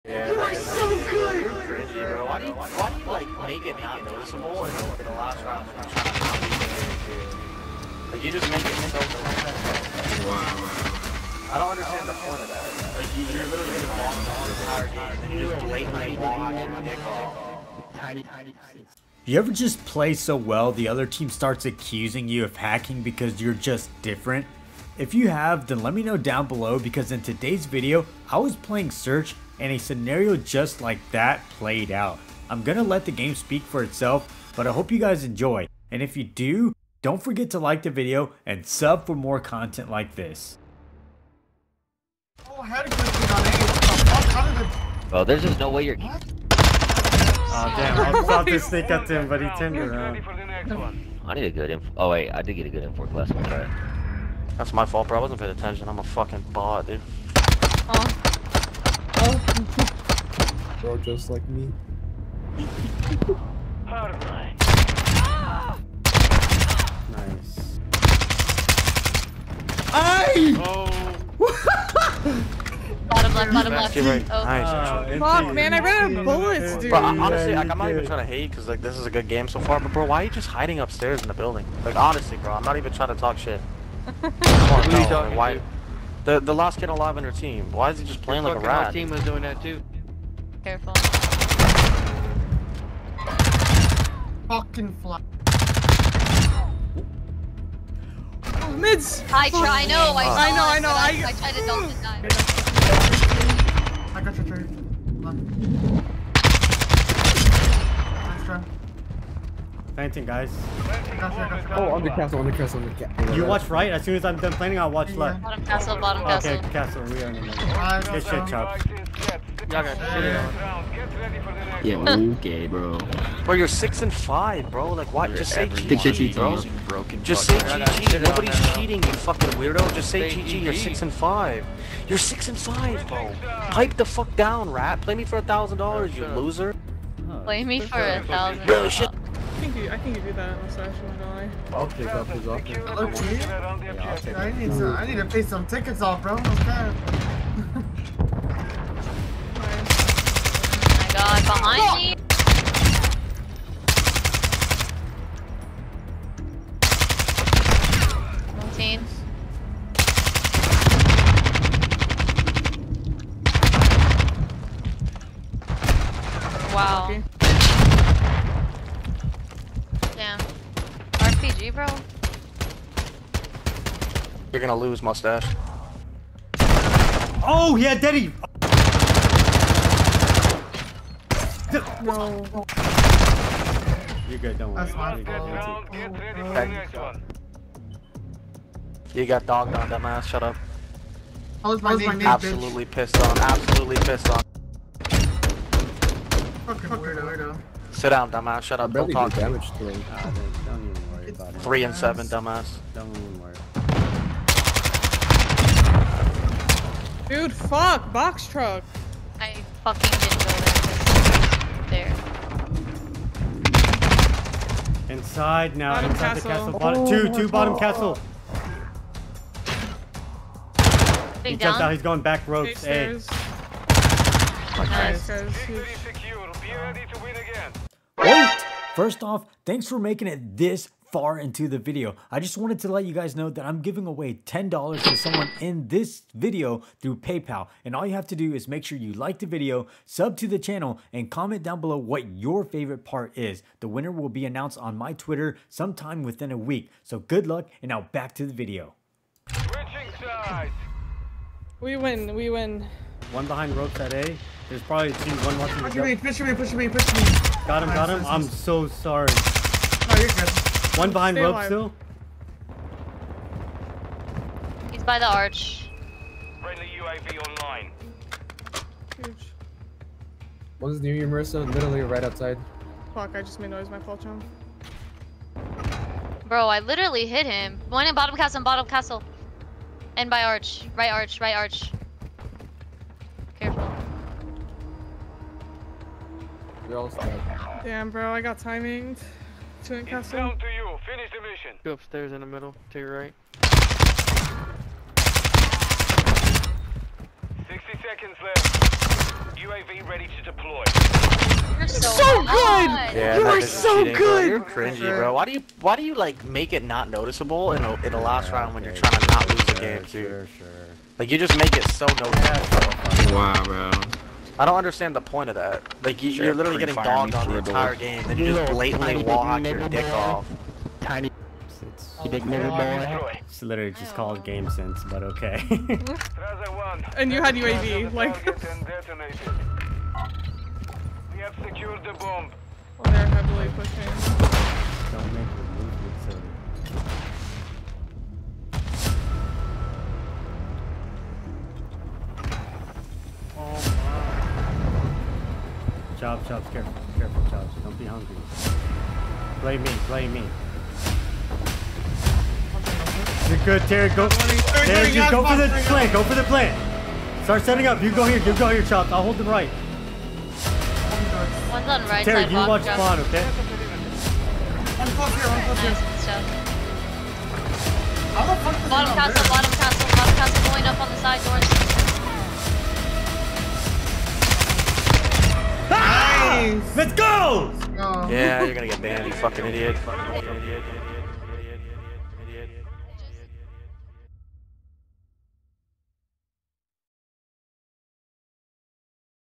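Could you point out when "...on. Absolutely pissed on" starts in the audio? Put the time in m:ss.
3:13.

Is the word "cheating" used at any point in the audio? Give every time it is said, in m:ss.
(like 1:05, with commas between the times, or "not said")
2:08, 5:04.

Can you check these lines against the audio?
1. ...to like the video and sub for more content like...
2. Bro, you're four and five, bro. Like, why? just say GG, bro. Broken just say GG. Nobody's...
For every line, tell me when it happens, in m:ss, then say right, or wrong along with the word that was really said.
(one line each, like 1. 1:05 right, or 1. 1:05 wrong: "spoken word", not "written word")
1. 0:37 right
2. 2:03 wrong: "six", not "four".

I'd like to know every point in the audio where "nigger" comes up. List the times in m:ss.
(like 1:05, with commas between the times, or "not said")
5:22.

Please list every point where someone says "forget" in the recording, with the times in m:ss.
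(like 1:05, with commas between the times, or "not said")
0:37.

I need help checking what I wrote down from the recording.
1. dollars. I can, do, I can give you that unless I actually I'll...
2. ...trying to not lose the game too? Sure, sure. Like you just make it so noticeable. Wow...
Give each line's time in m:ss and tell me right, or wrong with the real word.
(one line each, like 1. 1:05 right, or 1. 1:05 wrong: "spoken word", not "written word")
1. 2:18 right
2. 5:09 right.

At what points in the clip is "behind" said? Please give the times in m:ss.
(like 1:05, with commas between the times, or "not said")
2:31, 4:13, 4:21.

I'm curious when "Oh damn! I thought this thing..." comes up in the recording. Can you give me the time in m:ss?
0:46.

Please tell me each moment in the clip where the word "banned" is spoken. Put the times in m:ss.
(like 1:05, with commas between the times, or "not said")
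6:19.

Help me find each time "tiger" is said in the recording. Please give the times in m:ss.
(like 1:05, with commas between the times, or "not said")
not said.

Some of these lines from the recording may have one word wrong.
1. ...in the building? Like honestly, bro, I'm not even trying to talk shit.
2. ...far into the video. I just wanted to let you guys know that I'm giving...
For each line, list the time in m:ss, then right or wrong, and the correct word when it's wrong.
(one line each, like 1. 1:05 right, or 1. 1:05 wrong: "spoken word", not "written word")
1. 1:21 right
2. 3:51 right.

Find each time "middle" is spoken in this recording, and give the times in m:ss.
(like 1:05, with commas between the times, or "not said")
1:57, 4:52.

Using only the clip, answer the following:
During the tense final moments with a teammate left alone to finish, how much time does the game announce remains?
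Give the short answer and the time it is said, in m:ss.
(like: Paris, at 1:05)
60 seconds, at 4:53.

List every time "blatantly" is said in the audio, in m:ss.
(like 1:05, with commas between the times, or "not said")
0:15, 5:18.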